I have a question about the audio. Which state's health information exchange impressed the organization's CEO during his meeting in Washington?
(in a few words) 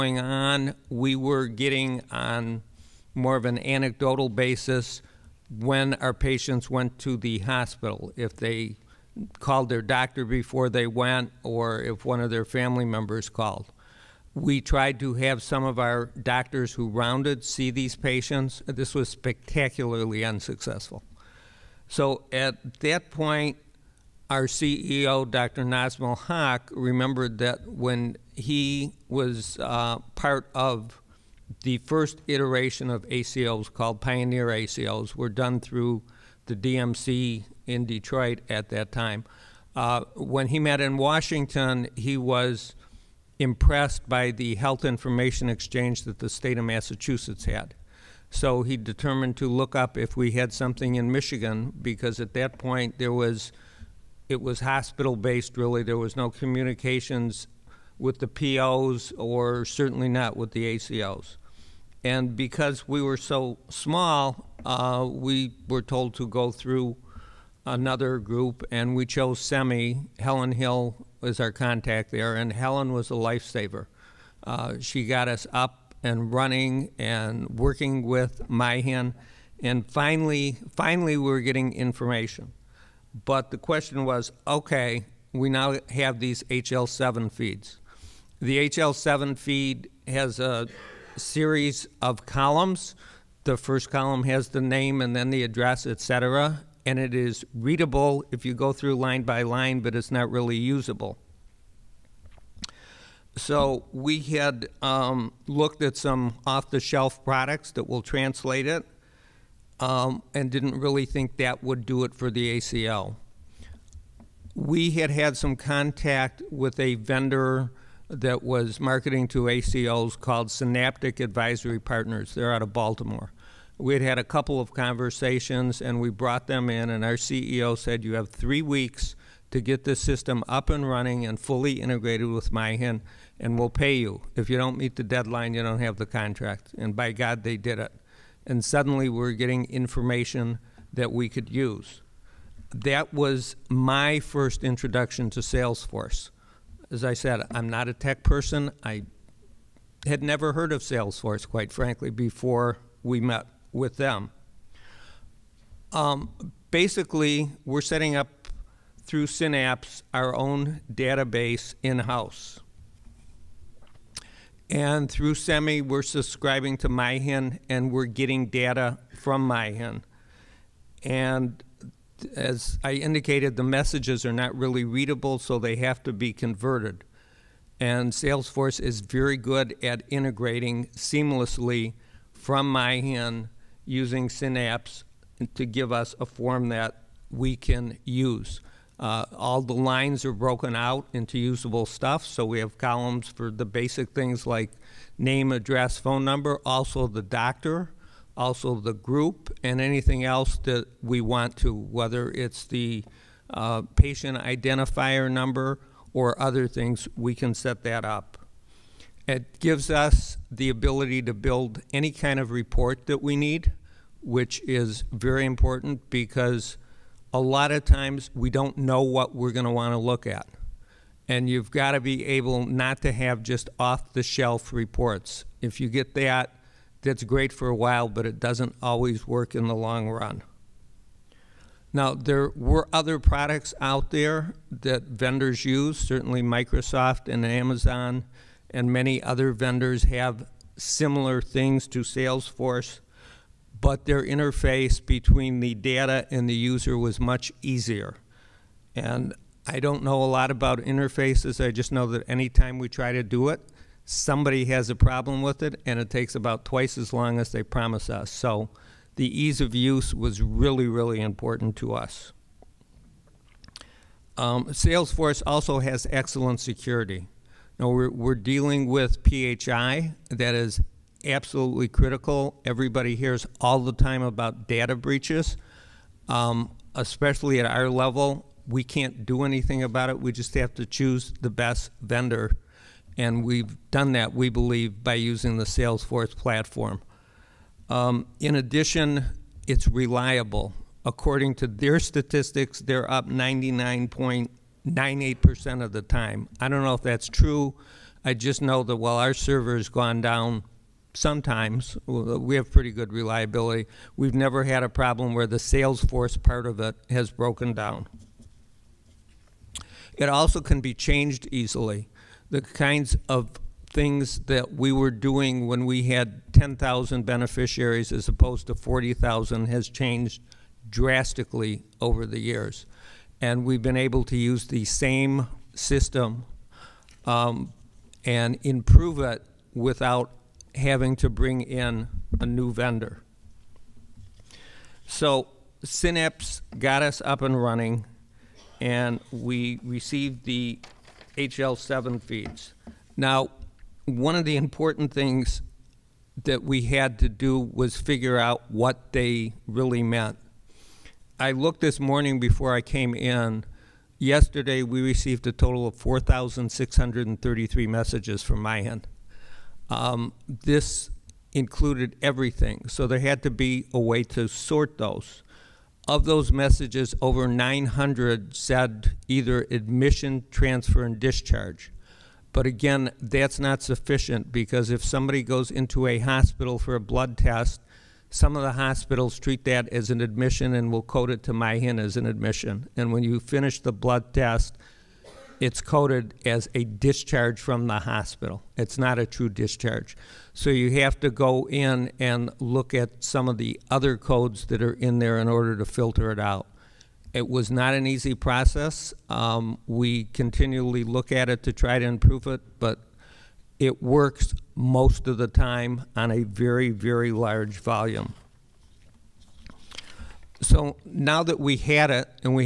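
Massachusetts.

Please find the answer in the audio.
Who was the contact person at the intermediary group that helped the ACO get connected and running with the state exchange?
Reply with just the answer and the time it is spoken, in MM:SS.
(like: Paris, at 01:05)
Helen Hill, at 01:10.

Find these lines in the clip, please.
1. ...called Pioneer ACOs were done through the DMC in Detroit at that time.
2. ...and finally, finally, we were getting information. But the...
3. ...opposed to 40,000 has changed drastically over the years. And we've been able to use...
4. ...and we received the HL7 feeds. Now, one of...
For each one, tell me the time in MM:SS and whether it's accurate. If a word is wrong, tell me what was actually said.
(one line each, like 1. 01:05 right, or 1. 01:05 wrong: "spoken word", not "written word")
1. 00:33 right
2. 01:19 right
3. 05:18 right
4. 05:38 right.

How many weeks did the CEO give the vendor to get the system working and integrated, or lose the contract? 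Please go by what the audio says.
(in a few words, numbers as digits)
3.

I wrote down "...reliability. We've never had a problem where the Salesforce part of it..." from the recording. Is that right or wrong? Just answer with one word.
right.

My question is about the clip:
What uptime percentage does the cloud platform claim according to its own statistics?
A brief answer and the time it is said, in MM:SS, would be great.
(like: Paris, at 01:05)
99.98%, at 04:53.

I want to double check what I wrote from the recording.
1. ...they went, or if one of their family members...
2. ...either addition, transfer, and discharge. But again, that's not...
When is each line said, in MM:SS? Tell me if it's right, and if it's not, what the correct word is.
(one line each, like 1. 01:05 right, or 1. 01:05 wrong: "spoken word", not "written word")
1. 00:10 right
2. 06:09 wrong: "admission", not "addition".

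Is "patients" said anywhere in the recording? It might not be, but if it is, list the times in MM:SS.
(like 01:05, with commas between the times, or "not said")
00:06, 00:17, 03:23.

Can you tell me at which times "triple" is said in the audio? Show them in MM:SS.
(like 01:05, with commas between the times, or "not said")
not said.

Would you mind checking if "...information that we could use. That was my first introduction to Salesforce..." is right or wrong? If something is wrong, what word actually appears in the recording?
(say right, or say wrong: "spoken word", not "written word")
right.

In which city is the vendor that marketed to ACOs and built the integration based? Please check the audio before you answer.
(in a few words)
Baltimore.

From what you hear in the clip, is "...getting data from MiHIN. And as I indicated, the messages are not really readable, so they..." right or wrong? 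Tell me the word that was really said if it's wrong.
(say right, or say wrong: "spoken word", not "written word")
right.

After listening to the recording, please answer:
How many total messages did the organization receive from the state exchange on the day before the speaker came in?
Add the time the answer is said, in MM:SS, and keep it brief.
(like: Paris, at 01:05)
4633, at 05:55.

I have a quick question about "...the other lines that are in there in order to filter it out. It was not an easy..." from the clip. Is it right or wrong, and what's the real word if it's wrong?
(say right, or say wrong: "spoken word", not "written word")
wrong: "codes", not "lines".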